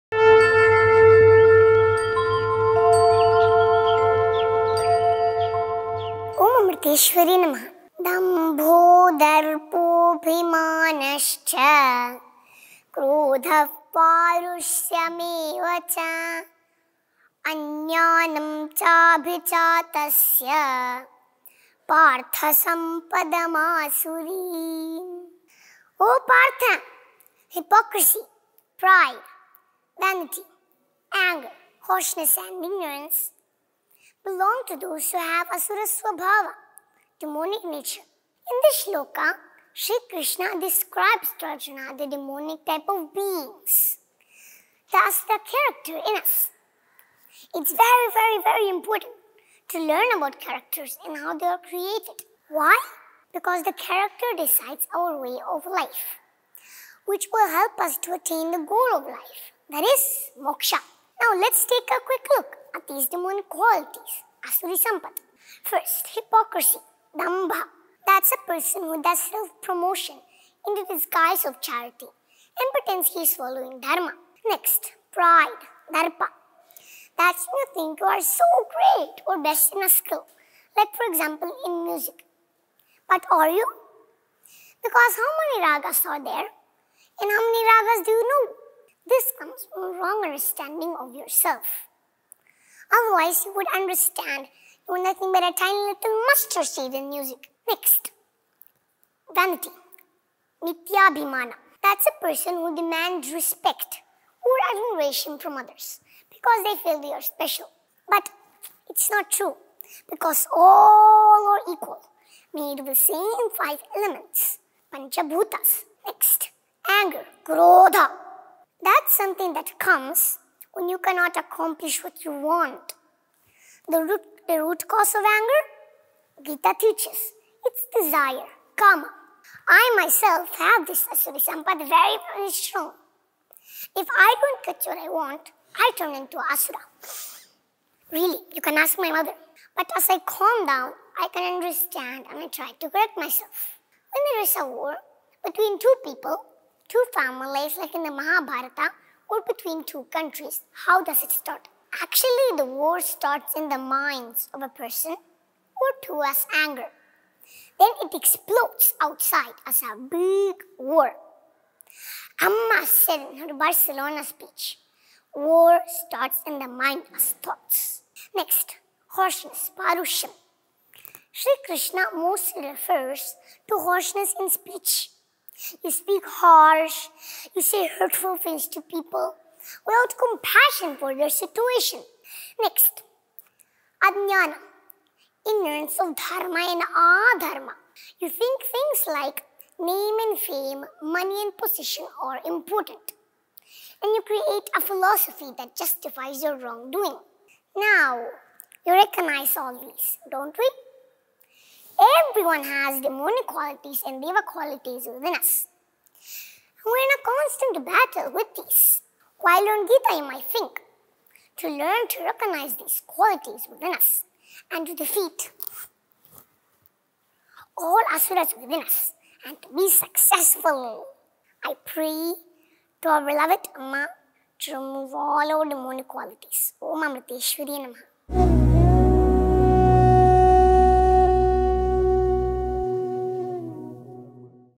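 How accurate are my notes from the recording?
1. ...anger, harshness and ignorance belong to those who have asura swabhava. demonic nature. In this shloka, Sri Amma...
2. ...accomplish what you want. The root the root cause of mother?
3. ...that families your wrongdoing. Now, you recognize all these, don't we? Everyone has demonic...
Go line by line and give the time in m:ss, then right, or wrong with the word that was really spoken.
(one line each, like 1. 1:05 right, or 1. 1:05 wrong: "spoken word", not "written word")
1. 0:31 wrong: "Krishna", not "Amma"
2. 2:01 wrong: "anger", not "mother"
3. 3:15 wrong: "justifies", not "families".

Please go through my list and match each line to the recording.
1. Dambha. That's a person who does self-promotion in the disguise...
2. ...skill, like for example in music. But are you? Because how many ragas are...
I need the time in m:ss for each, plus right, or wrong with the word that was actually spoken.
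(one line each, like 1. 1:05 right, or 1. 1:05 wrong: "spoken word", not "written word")
1. 1:07 right
2. 1:19 right.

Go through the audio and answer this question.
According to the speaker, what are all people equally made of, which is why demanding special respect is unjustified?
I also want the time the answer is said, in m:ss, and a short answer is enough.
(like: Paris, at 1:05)
Panchabhutas, at 1:54.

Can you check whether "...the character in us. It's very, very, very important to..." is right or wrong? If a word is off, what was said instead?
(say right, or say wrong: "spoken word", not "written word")
right.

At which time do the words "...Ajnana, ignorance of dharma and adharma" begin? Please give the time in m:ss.
3:04.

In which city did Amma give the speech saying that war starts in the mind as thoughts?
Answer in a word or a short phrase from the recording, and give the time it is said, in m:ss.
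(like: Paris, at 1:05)
Barcelona, at 2:43.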